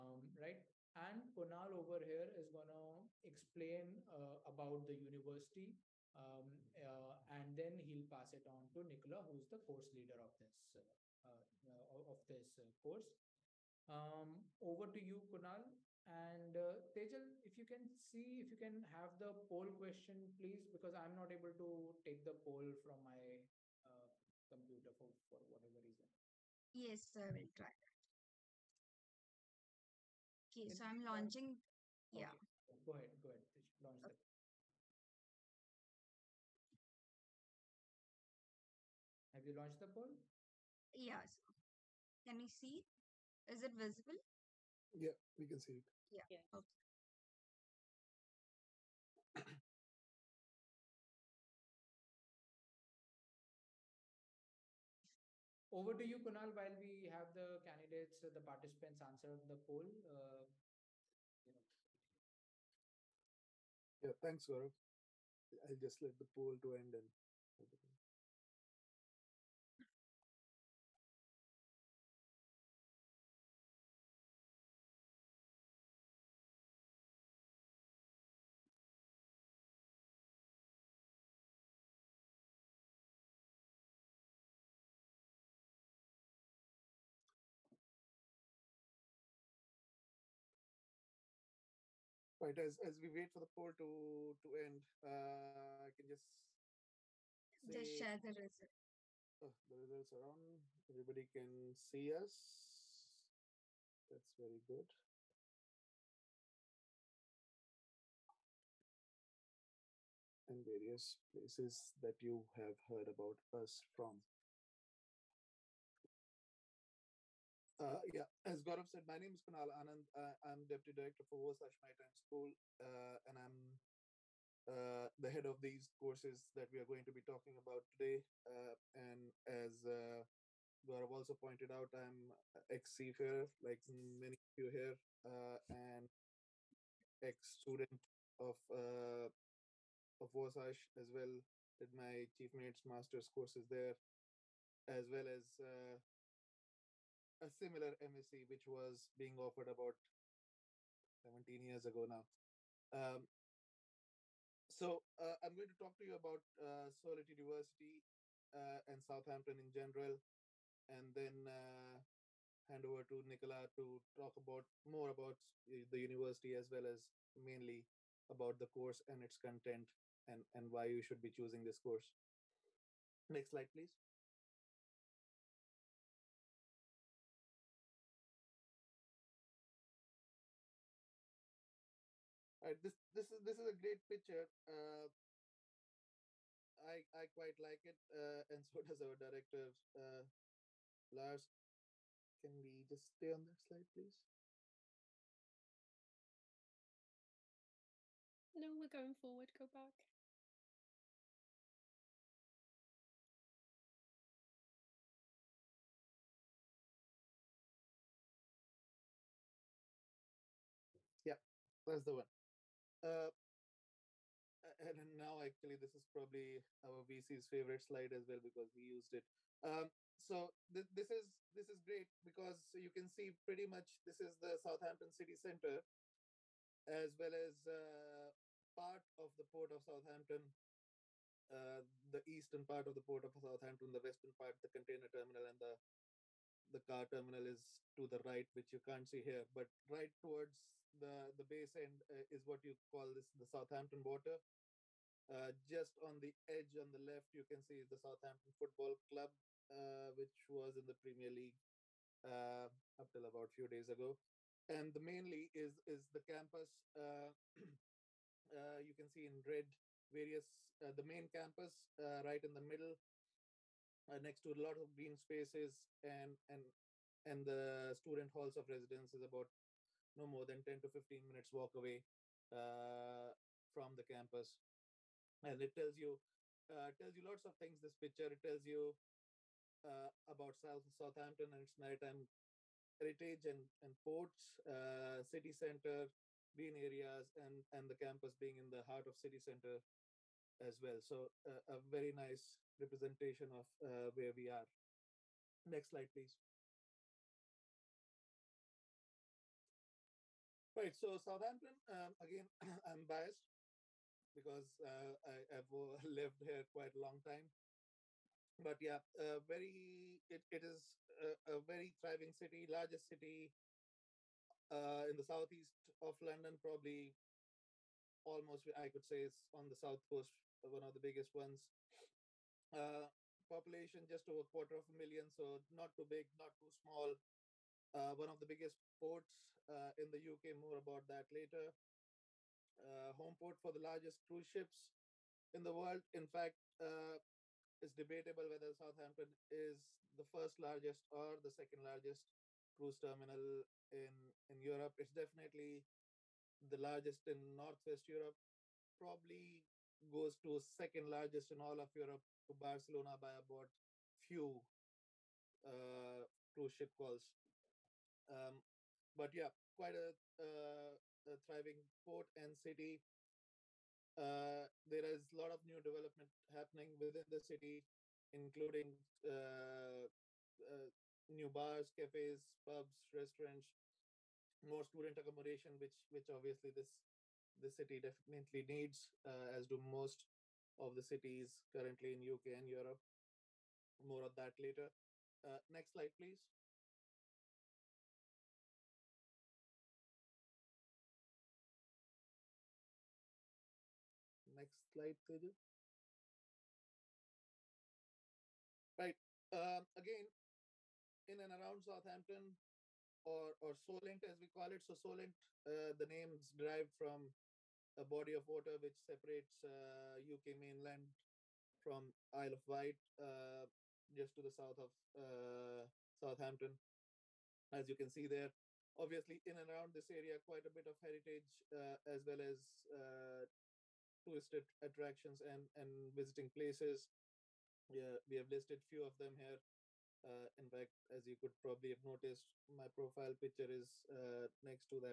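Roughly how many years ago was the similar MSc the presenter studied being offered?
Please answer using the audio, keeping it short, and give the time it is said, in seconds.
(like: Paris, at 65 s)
17 years, at 149 s.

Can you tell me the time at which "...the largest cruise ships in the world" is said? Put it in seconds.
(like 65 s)
333 s.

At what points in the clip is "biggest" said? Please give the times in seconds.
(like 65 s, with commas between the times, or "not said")
320 s, 328 s.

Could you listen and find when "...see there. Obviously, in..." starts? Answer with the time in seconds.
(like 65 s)
418 s.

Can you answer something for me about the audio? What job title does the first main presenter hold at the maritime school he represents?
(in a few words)
Deputy Director.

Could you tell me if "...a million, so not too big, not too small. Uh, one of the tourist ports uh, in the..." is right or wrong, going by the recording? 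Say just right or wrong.
wrong.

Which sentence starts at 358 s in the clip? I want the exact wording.
Um, but yeah, quite a, a thriving port and city.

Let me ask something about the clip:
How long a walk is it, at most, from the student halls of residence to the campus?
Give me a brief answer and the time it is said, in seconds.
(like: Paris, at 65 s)
10 to 15 minutes, at 270 s.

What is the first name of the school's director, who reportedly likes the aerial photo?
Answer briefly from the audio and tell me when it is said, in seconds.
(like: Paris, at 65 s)
Lars, at 191 s.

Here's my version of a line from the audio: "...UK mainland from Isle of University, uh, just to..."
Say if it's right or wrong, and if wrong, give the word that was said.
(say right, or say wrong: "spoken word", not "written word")
wrong: "Wight", not "University".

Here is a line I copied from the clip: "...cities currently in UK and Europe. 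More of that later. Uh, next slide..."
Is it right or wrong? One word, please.
right.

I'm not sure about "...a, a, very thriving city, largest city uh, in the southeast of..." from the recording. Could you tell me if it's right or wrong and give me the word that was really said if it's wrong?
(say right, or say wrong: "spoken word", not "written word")
right.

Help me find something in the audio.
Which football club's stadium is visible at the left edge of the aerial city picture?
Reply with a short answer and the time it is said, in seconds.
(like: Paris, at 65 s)
Southampton Football Club, at 247 s.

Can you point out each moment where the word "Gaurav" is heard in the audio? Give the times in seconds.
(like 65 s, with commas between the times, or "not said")
64 s, 118 s, 130 s.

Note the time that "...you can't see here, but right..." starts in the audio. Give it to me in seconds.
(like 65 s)
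238 s.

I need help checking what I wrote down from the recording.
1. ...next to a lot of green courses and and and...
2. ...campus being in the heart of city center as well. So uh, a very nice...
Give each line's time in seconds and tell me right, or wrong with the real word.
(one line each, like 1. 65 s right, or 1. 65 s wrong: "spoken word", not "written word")
1. 264 s wrong: "spaces", not "courses"
2. 287 s right.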